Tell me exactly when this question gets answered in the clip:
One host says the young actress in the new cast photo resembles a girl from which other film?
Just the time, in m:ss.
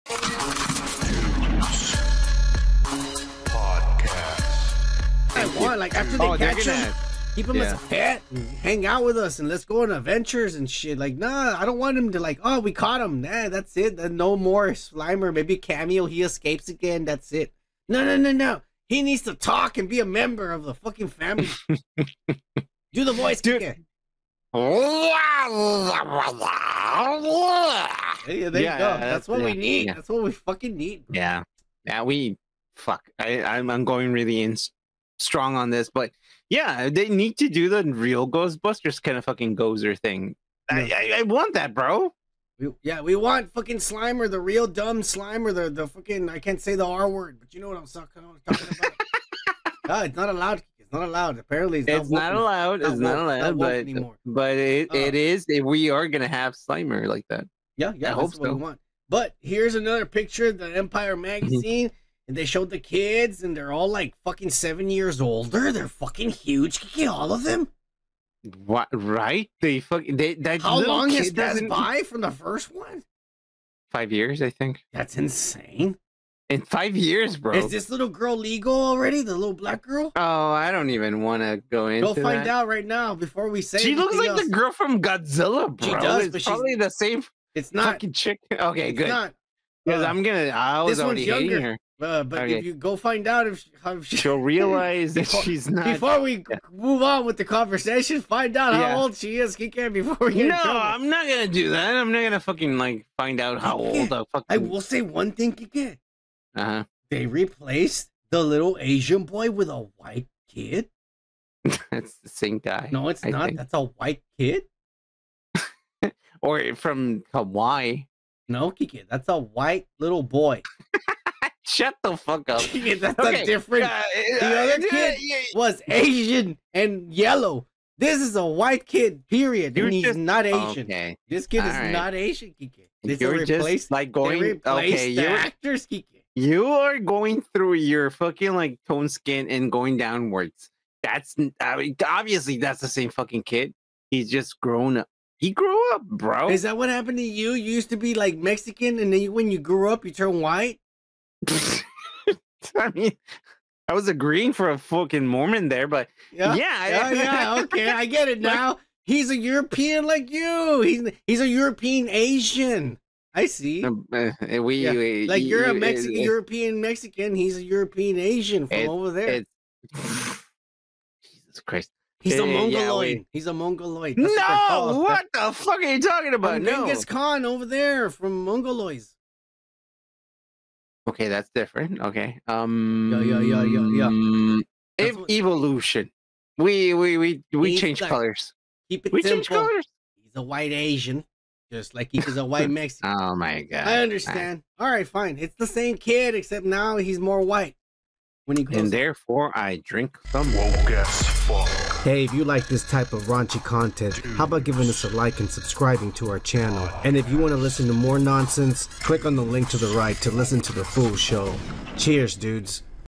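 1:25.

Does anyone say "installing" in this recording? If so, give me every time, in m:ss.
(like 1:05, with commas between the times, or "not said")
not said.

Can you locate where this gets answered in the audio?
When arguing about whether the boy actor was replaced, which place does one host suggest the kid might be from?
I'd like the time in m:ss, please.
1:57.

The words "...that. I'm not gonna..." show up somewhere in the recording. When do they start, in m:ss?
1:41.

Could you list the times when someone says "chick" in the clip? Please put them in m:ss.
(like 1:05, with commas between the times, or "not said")
1:28.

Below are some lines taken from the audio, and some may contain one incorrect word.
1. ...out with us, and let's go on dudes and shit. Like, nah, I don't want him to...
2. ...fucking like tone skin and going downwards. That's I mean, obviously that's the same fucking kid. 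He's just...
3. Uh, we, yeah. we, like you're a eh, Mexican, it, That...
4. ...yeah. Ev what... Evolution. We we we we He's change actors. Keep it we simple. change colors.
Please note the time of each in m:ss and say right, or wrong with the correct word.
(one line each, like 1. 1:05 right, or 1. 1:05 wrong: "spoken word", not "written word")
1. 0:08 wrong: "adventures", not "dudes"
2. 2:18 right
3. 2:43 wrong: "European", not "That"
4. 3:04 wrong: "colors", not "actors".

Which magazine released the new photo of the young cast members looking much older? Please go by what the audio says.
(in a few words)
Empire.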